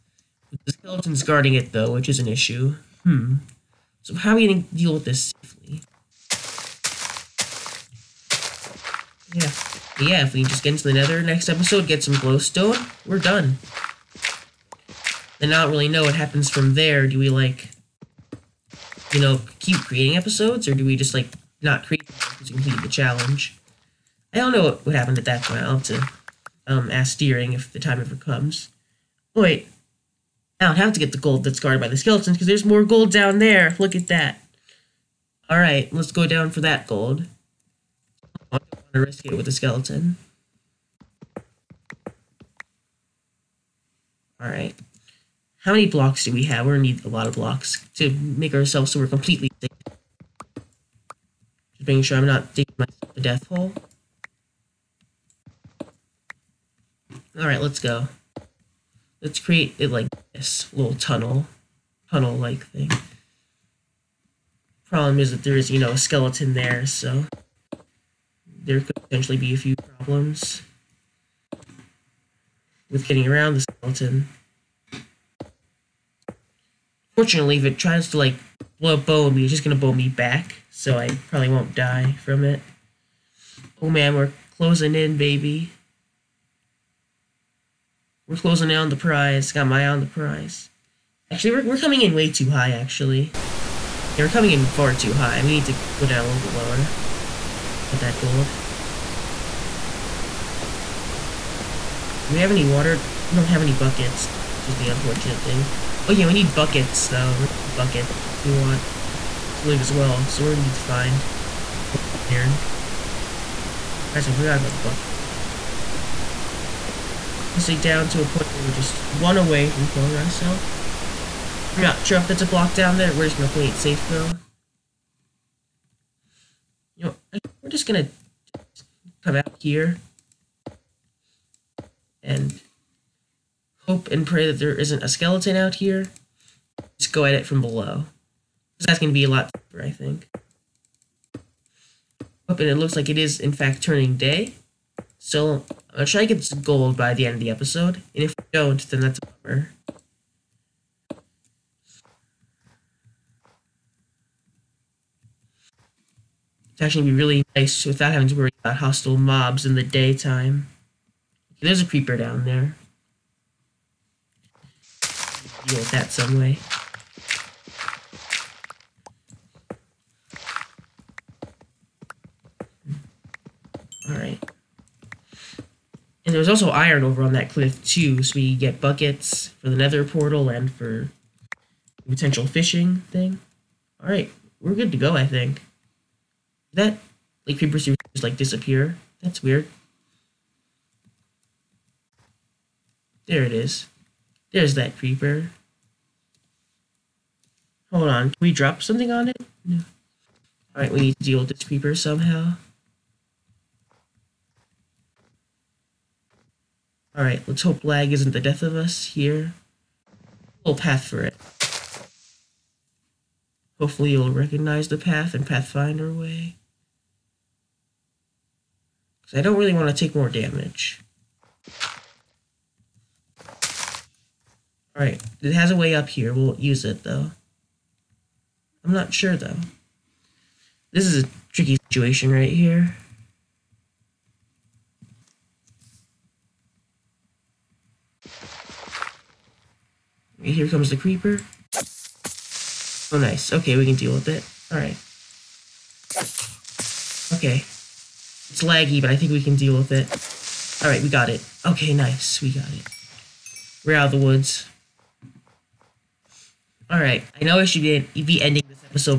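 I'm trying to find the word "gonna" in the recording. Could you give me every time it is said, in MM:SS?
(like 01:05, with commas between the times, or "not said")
00:46, 01:19, 01:50, 02:03, 02:07.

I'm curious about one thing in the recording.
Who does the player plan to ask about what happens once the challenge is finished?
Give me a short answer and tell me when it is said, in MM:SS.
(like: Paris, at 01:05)
Deering, at 00:27.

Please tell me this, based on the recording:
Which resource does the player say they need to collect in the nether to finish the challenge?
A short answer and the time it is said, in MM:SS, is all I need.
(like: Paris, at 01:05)
Glowstone, at 00:12.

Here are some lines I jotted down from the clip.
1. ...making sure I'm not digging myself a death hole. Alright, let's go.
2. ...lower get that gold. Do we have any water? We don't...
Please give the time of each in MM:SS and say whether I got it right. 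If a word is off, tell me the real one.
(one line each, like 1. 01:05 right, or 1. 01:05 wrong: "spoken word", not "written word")
1. 00:51 right
2. 01:36 right.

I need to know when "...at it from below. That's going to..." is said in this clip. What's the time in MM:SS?
02:17.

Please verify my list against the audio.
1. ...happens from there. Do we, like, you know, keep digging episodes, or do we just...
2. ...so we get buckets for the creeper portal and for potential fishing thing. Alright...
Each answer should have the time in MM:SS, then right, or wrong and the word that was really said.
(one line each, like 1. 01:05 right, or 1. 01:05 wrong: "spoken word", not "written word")
1. 00:16 wrong: "creating", not "digging"
2. 02:58 wrong: "nether", not "creeper".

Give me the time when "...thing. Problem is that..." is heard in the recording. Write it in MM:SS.
01:02.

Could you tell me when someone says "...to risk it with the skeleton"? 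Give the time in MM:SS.
00:38.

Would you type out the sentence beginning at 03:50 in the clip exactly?
This is a tricky situation right here.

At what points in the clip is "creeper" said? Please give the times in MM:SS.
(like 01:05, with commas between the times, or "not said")
02:41, 03:07, 03:14, 03:21, 04:00.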